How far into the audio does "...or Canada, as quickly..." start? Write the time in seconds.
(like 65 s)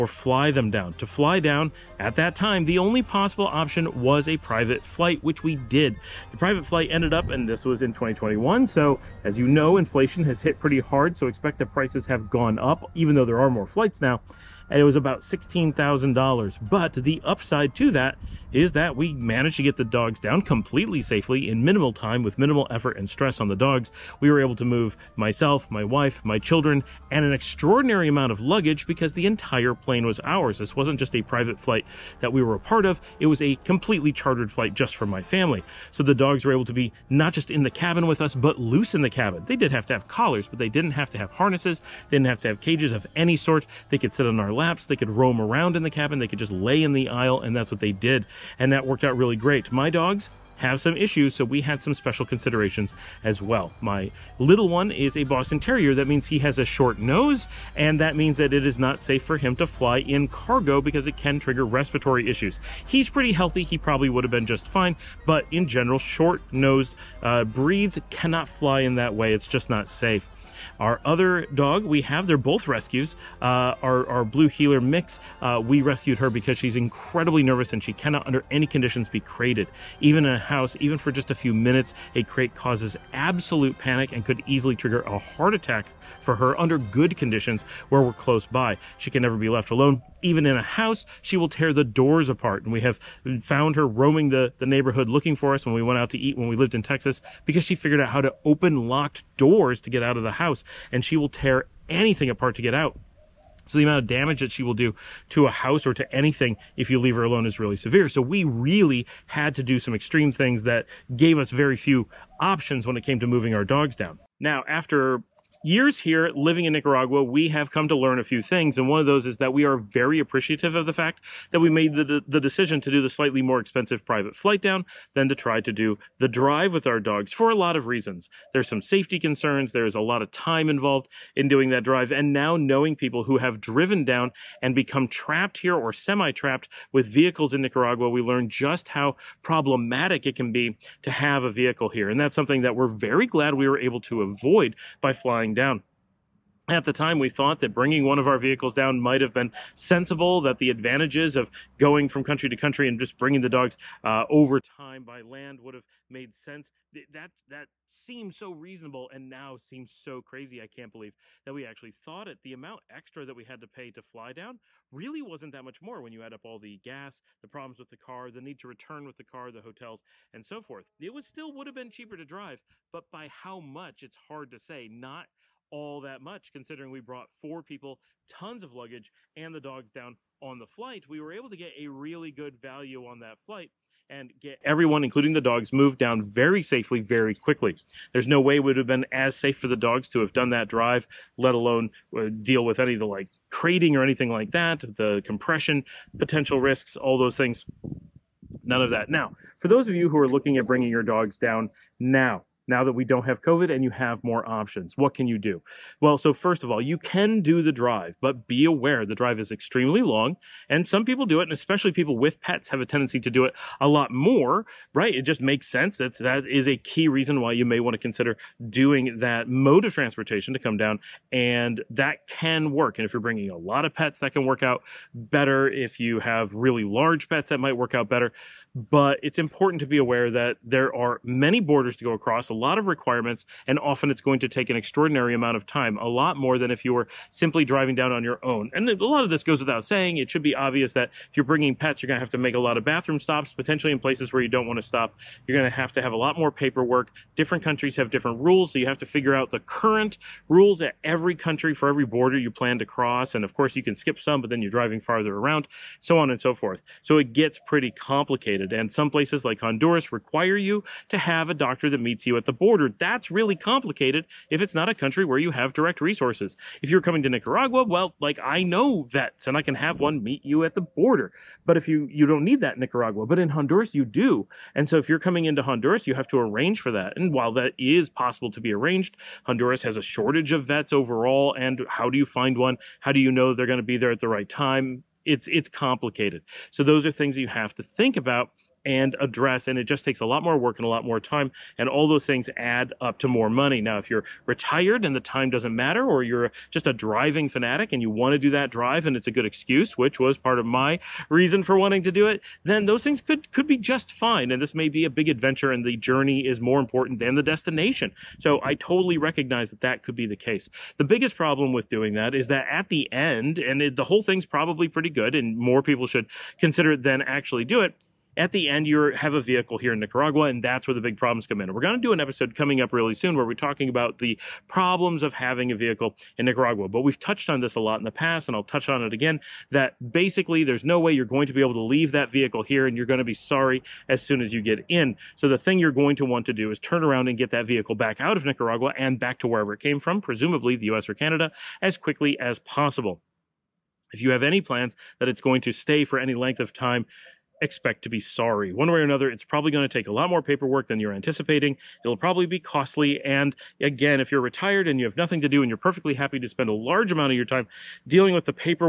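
341 s.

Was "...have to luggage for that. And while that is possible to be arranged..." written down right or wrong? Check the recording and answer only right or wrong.
wrong.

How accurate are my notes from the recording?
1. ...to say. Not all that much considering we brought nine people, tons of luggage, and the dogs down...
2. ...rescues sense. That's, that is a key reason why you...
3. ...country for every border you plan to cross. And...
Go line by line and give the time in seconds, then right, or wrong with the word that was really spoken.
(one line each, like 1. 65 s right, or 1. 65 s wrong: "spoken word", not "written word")
1. 174 s wrong: "four", not "nine"
2. 215 s wrong: "makes", not "rescues"
3. 251 s right.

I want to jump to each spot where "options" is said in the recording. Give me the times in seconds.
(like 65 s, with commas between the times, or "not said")
3 s, 112 s, 204 s.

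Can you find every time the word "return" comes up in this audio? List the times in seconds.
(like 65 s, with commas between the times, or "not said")
168 s.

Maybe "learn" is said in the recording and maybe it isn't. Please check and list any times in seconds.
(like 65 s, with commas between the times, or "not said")
117 s, 138 s.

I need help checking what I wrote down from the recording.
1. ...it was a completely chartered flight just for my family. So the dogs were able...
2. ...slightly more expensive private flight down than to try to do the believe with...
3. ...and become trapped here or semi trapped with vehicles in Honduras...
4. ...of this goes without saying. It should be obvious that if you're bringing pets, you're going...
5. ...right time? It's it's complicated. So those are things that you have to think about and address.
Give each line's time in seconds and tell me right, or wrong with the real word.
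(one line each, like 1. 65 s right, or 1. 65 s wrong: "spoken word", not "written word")
1. 33 s right
2. 123 s wrong: "drive", not "believe"
3. 134 s wrong: "Nicaragua", not "Honduras"
4. 239 s right
5. 284 s right.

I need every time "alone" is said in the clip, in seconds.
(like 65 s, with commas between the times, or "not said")
89 s, 107 s, 191 s.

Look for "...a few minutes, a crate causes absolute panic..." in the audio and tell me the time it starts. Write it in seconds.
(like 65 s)
81 s.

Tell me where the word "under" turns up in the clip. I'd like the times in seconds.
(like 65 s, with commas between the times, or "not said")
78 s, 86 s.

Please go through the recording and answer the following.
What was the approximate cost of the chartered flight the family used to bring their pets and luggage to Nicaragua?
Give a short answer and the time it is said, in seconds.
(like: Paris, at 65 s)
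$16,000, at 15 s.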